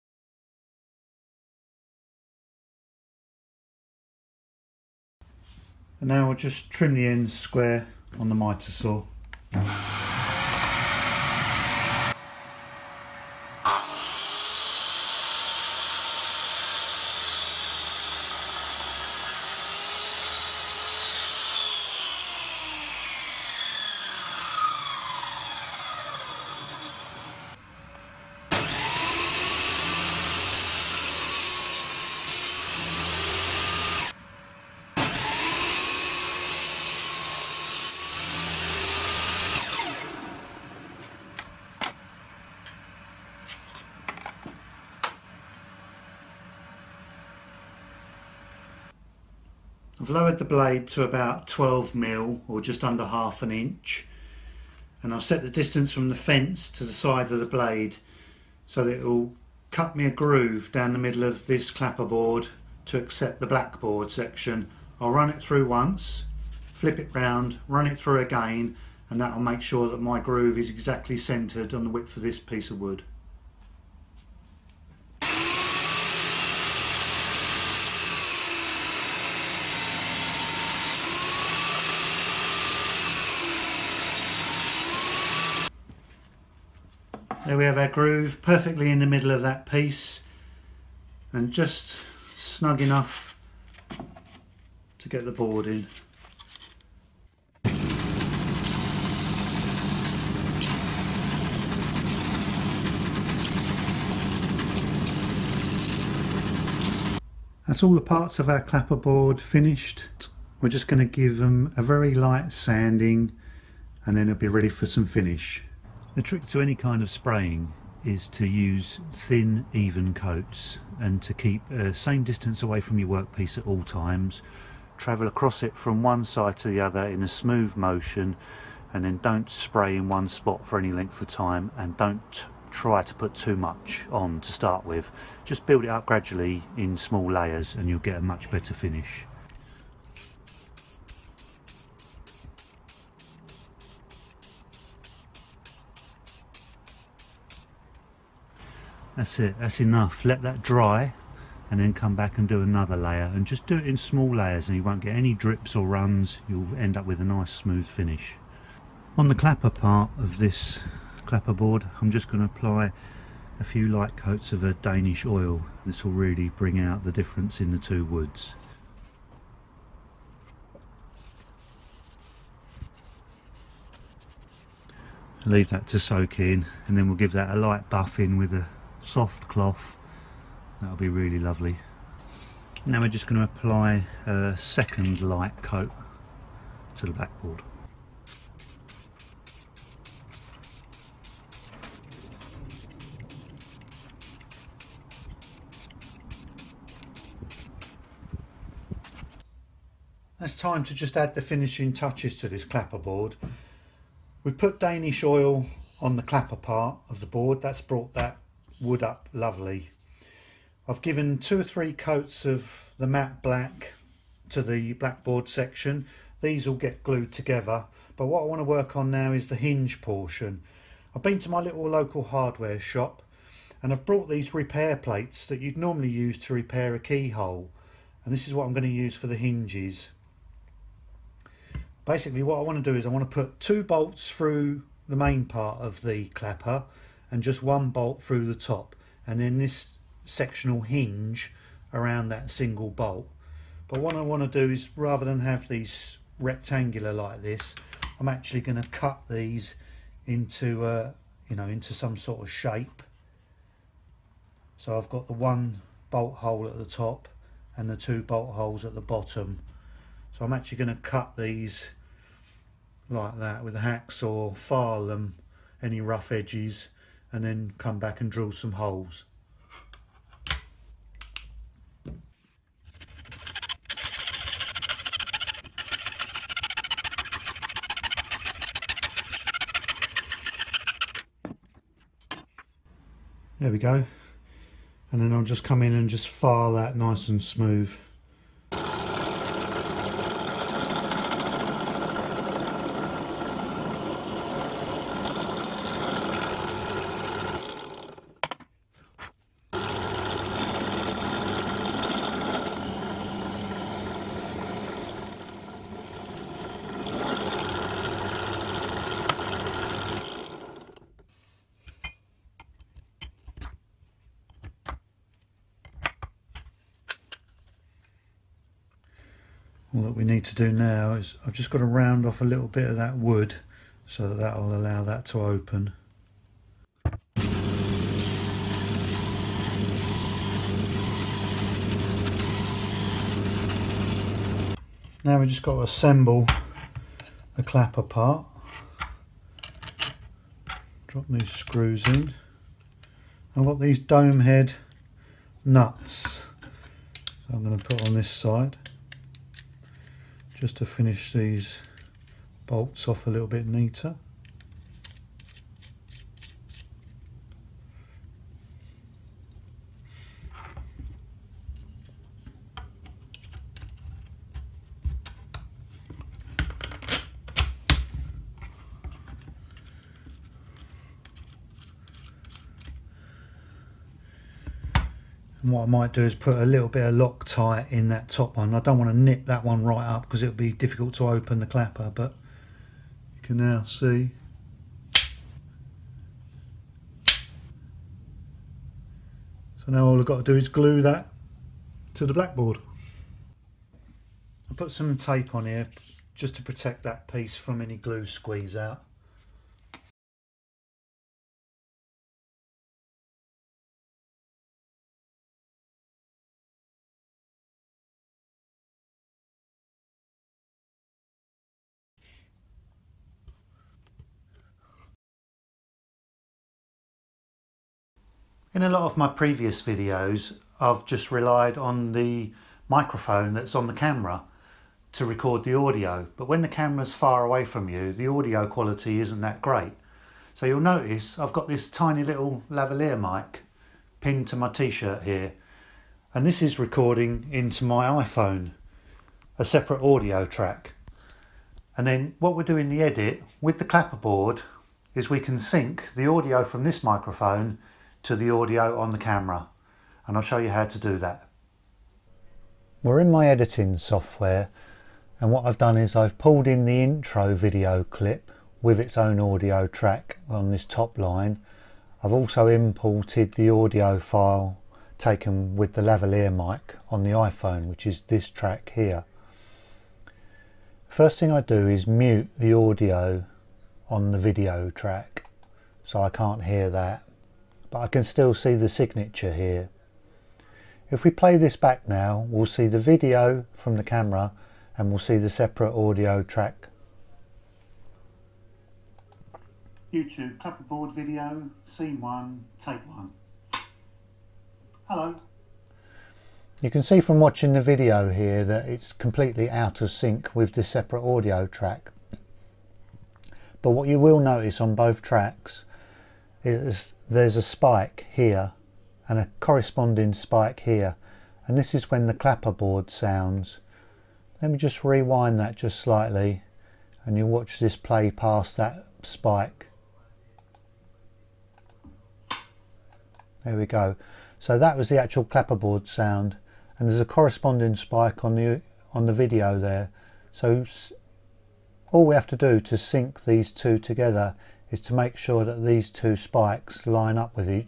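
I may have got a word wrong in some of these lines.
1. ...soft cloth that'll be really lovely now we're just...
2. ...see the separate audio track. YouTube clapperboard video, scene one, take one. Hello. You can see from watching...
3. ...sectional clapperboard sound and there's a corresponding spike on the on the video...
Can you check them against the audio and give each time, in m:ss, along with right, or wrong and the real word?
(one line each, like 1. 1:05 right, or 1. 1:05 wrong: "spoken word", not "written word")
1. 2:59 right
2. 8:05 right
3. 8:45 wrong: "actual", not "sectional".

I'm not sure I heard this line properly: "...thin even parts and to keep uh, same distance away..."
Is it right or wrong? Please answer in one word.
wrong.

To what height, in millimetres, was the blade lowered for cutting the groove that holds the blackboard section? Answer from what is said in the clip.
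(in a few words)
12.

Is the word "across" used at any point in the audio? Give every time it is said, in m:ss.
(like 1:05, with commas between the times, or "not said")
2:05.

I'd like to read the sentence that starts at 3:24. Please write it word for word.
We've put Danish oil on the clapper part of the board, that's brought that wood up lovely.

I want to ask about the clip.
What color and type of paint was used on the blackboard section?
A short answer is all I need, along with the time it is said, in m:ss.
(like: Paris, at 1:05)
matte black, at 3:33.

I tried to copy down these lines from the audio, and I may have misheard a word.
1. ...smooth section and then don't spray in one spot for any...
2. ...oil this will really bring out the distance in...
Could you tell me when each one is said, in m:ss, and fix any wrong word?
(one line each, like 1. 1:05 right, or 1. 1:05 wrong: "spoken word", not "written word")
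1. 2:07 wrong: "motion", not "section"
2. 2:45 wrong: "difference", not "distance".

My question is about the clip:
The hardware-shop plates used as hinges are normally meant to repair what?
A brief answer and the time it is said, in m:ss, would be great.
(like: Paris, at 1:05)
a keyhole, at 3:46.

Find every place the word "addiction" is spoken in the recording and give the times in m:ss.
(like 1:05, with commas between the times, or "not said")
not said.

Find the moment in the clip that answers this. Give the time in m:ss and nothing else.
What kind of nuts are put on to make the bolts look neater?
5:43.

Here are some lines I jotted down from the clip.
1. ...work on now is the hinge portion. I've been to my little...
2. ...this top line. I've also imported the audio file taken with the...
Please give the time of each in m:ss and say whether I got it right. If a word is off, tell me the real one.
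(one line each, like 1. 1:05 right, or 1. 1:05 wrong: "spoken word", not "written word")
1. 3:38 right
2. 7:40 right.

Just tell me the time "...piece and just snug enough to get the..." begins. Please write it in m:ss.
1:29.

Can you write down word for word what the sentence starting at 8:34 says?
Let me just rewind that just slightly and you watch this play past that spike.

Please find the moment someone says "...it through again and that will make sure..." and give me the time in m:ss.
1:07.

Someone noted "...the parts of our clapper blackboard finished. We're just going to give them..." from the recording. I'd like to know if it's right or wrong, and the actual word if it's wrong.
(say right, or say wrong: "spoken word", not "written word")
wrong: "board", not "blackboard".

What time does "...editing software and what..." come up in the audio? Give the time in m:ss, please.
7:33.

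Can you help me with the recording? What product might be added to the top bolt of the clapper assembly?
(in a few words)
Loctite.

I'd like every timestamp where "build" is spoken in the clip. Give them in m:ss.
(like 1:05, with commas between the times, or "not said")
2:15.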